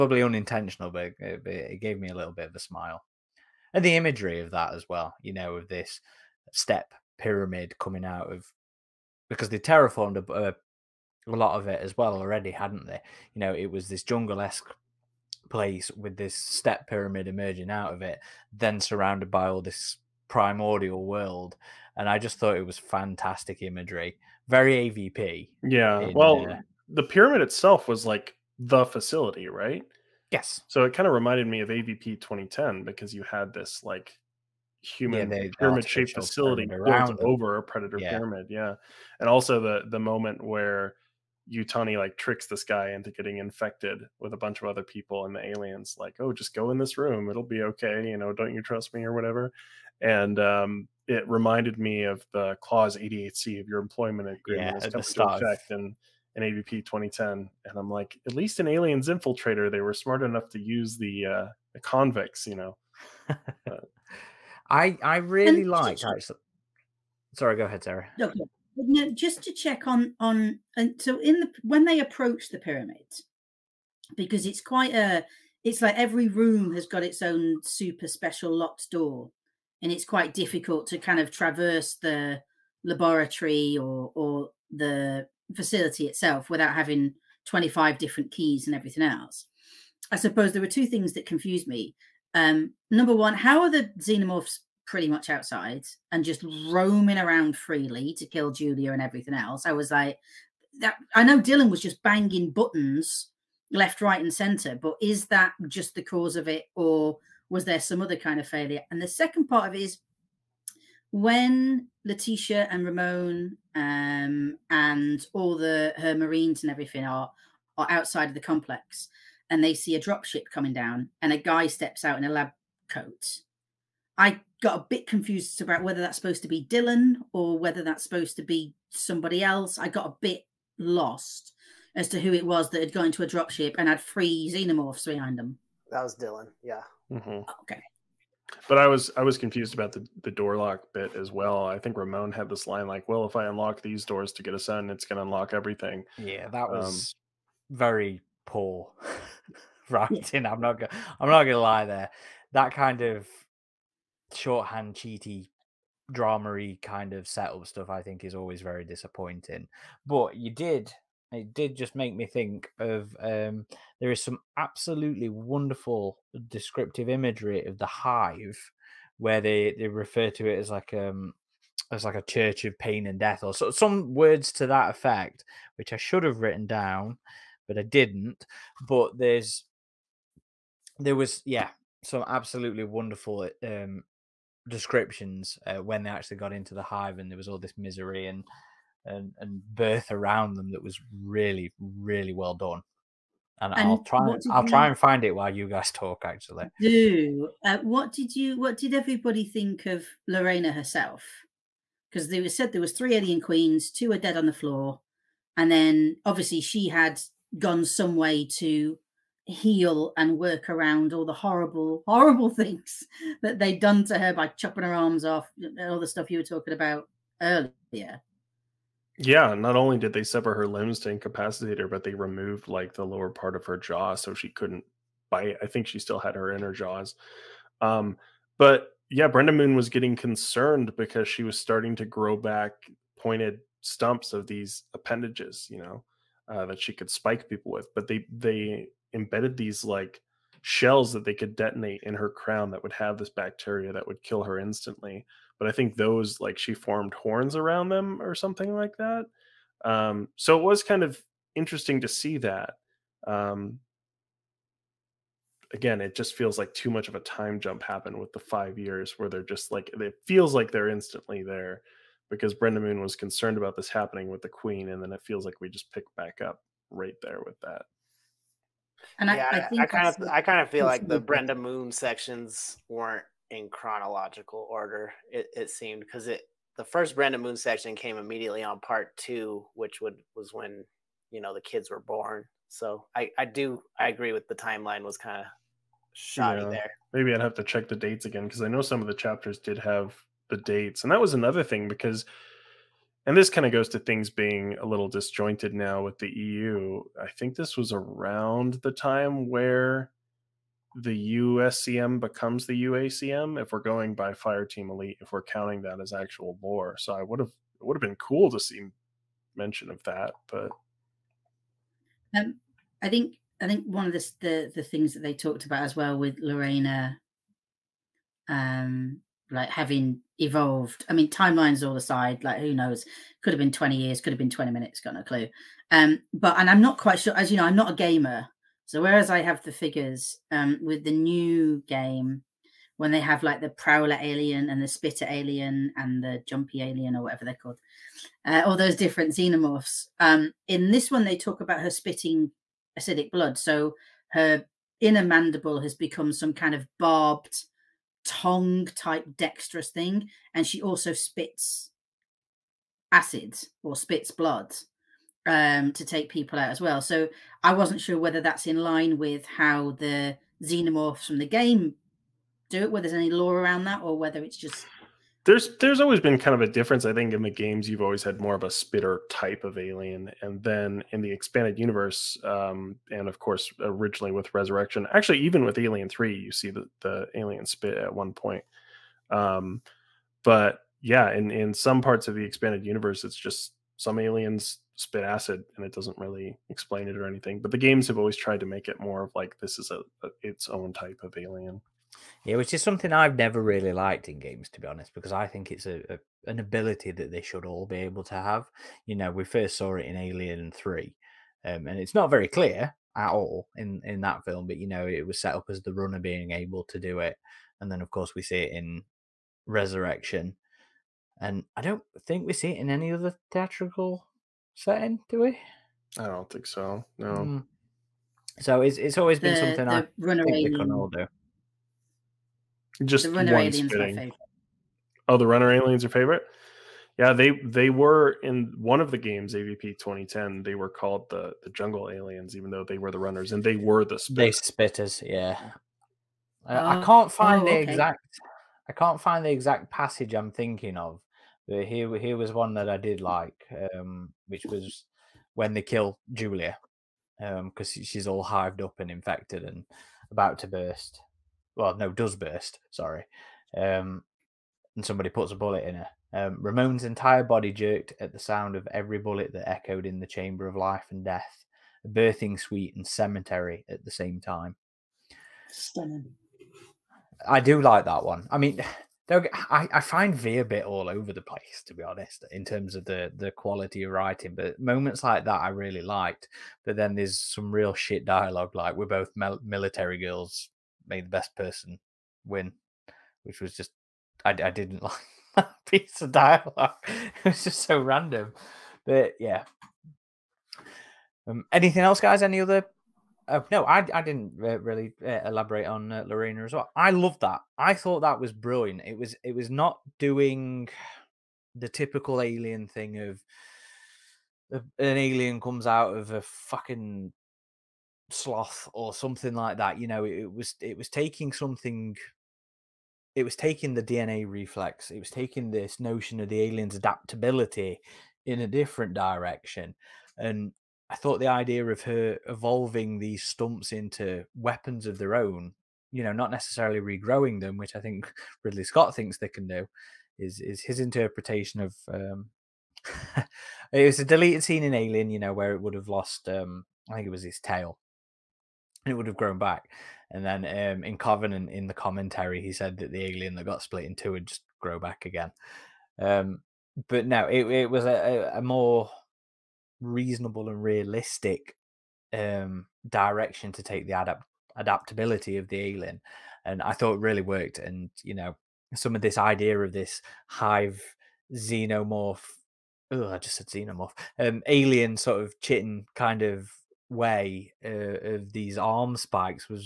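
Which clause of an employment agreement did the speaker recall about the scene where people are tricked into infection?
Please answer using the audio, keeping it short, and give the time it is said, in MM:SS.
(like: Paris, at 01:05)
88C, at 00:52.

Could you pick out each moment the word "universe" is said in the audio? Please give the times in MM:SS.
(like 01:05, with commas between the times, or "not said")
06:11, 06:22.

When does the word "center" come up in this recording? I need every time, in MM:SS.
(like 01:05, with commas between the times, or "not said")
01:44.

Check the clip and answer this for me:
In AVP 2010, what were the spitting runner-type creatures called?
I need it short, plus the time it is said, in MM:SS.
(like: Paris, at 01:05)
jungle aliens, at 07:11.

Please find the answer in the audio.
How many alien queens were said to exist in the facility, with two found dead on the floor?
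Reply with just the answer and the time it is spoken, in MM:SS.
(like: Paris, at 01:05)
3, at 03:22.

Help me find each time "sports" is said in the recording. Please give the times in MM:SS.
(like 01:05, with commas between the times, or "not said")
not said.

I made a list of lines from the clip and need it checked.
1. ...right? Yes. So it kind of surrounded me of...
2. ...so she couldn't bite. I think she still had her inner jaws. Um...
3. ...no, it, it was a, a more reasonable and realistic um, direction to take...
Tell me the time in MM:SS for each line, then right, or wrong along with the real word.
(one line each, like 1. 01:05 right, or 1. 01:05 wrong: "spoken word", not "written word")
1. 00:29 wrong: "reminded", not "surrounded"
2. 03:44 right
3. 09:07 right.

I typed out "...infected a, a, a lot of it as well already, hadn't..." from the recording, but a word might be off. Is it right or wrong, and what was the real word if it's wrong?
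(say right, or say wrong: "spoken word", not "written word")
wrong: "terraformed", not "infected".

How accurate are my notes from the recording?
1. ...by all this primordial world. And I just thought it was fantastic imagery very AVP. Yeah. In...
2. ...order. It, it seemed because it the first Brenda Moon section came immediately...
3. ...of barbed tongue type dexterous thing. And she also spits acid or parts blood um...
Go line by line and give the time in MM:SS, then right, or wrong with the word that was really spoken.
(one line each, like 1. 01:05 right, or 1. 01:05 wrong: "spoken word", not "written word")
1. 00:19 right
2. 04:34 right
3. 05:46 wrong: "spits", not "parts".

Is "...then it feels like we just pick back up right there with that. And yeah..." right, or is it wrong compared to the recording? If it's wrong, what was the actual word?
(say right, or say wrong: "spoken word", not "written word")
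right.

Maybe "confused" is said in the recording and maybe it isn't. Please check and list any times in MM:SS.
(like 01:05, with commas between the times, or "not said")
01:31, 02:05, 02:19.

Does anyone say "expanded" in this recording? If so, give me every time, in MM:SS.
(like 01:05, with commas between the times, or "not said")
06:11, 06:22.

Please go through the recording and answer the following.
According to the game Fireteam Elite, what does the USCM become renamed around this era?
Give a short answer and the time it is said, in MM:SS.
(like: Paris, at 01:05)
UACM, at 05:02.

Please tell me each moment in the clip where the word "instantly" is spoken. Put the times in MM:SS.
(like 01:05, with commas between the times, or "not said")
04:04, 04:20.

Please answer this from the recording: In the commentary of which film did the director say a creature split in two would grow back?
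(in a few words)
Covenant.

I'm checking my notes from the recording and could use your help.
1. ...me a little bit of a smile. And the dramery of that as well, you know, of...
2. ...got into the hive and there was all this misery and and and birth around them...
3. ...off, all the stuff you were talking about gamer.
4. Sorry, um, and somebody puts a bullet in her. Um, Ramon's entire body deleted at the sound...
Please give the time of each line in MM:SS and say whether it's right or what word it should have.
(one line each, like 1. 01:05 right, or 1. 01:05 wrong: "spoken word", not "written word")
1. 00:01 wrong: "imagery", not "dramery"
2. 03:06 right
3. 03:35 wrong: "earlier", not "gamer"
4. 07:32 wrong: "jerked", not "deleted".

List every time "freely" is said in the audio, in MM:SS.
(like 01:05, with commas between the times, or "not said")
01:37.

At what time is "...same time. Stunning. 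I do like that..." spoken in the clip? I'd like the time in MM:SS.
07:44.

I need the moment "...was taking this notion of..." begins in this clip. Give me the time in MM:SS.
08:35.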